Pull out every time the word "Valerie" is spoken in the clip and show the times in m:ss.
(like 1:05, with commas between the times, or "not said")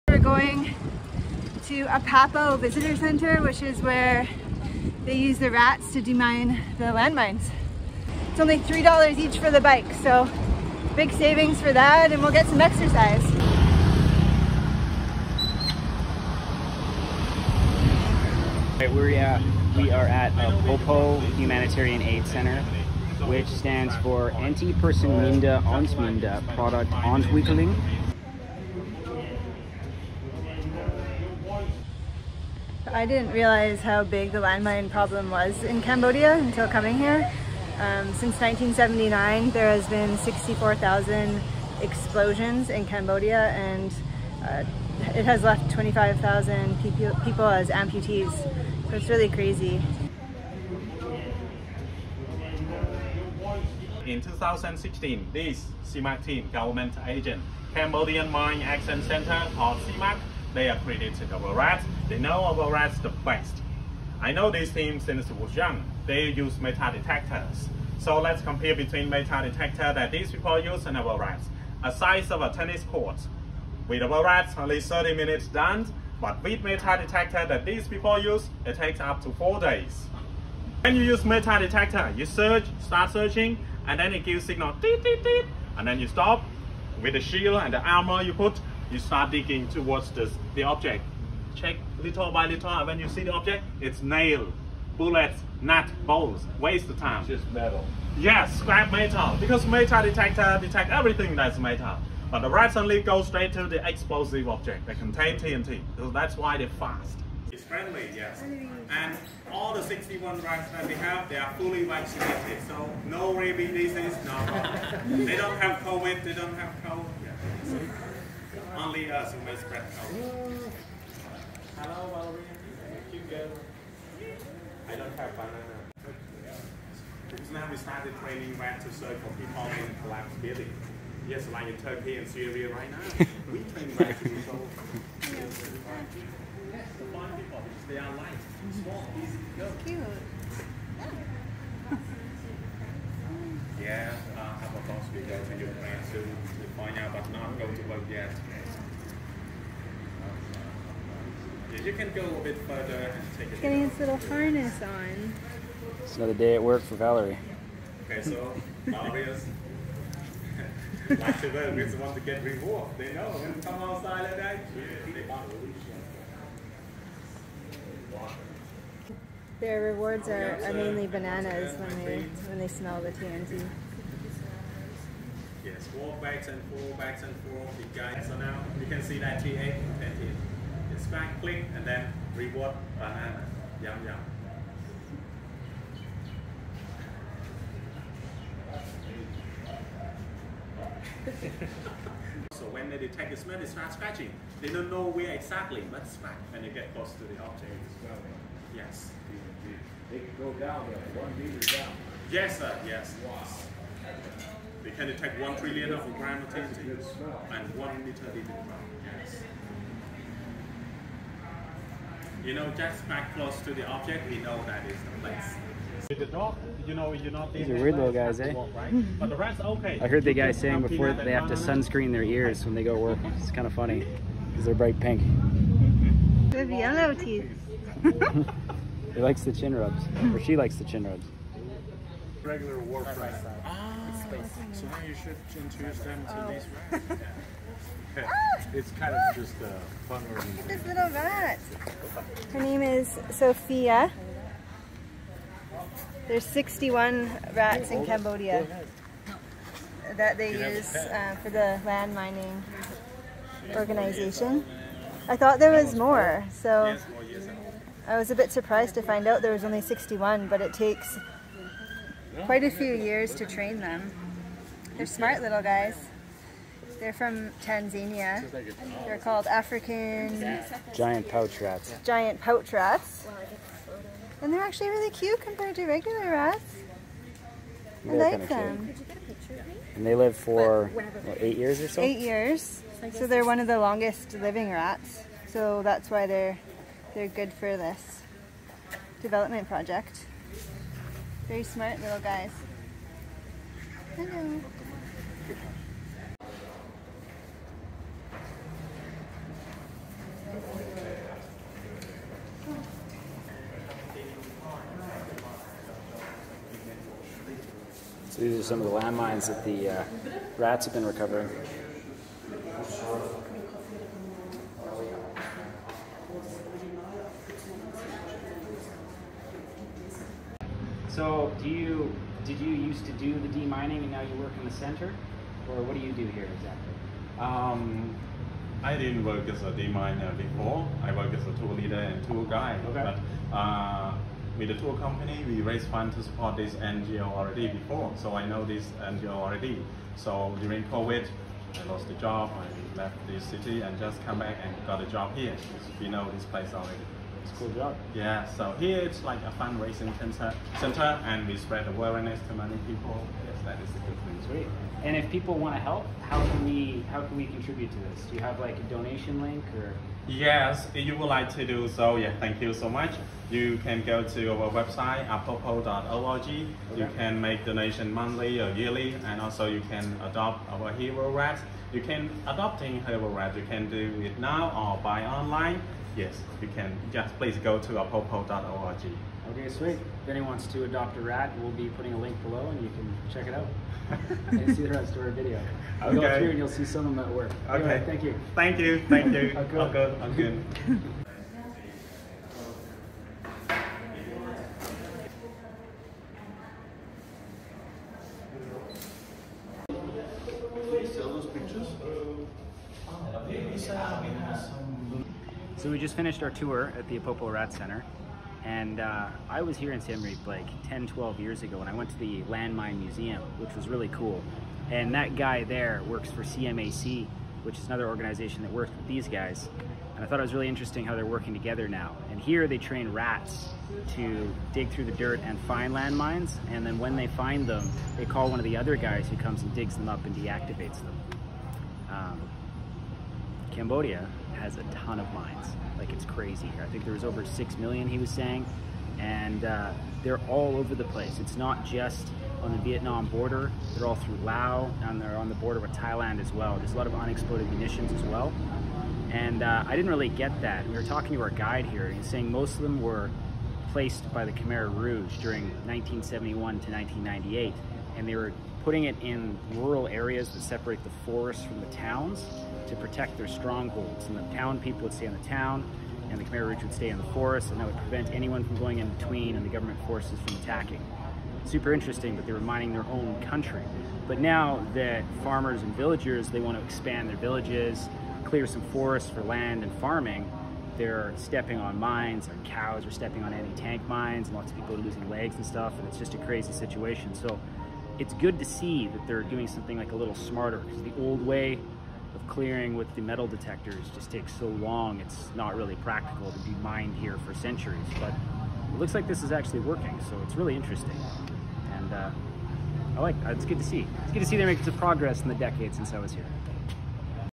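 2:02, 2:36.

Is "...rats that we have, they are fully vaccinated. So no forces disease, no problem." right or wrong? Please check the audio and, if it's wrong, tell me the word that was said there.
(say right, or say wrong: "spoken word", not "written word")
wrong: "rabies", not "forces".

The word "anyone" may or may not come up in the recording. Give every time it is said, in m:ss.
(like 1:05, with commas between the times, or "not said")
6:20, 7:48.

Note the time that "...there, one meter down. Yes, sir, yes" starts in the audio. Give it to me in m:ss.
3:20.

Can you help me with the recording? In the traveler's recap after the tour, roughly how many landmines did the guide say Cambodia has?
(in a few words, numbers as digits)
over 6 million.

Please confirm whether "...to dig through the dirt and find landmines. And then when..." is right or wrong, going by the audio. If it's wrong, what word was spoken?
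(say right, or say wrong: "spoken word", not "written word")
right.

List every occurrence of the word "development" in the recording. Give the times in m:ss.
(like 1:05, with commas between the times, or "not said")
4:49.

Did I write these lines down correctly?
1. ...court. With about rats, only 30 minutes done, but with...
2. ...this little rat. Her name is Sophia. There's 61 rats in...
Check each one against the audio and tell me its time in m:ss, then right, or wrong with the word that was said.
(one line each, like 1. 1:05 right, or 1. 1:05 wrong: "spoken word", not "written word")
1. 1:12 right
2. 4:00 right.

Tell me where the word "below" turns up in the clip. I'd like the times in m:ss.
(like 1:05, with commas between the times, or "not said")
6:22.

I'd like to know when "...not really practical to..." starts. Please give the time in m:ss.
8:15.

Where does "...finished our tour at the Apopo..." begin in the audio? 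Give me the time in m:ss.
6:46.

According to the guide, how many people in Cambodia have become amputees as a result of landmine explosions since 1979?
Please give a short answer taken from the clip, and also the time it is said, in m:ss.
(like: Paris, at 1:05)
25,000, at 0:45.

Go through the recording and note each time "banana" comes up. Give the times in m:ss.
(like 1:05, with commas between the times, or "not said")
2:05, 2:51, 3:02.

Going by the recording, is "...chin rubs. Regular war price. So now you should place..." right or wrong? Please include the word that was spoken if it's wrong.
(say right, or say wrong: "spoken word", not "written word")
wrong: "introduce", not "place".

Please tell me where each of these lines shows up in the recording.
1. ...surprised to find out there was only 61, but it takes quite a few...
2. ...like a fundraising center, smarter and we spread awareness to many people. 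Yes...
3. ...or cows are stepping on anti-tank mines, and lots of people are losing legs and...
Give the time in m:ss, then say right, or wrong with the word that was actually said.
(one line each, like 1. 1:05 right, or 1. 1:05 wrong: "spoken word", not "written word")
1. 4:18 right
2. 5:49 wrong: "center", not "smarter"
3. 8:02 right.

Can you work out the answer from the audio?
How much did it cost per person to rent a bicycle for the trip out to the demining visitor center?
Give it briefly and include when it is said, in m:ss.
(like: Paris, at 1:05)
$3, at 0:08.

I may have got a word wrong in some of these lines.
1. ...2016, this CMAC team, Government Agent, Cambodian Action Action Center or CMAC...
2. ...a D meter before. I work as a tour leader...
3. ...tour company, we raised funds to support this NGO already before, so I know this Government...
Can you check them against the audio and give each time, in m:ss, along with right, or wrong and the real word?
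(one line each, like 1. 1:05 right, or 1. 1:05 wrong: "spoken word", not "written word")
1. 0:54 wrong: "Mine", not "Action"
2. 5:29 wrong: "miner", not "meter"
3. 5:34 wrong: "NGO", not "Government".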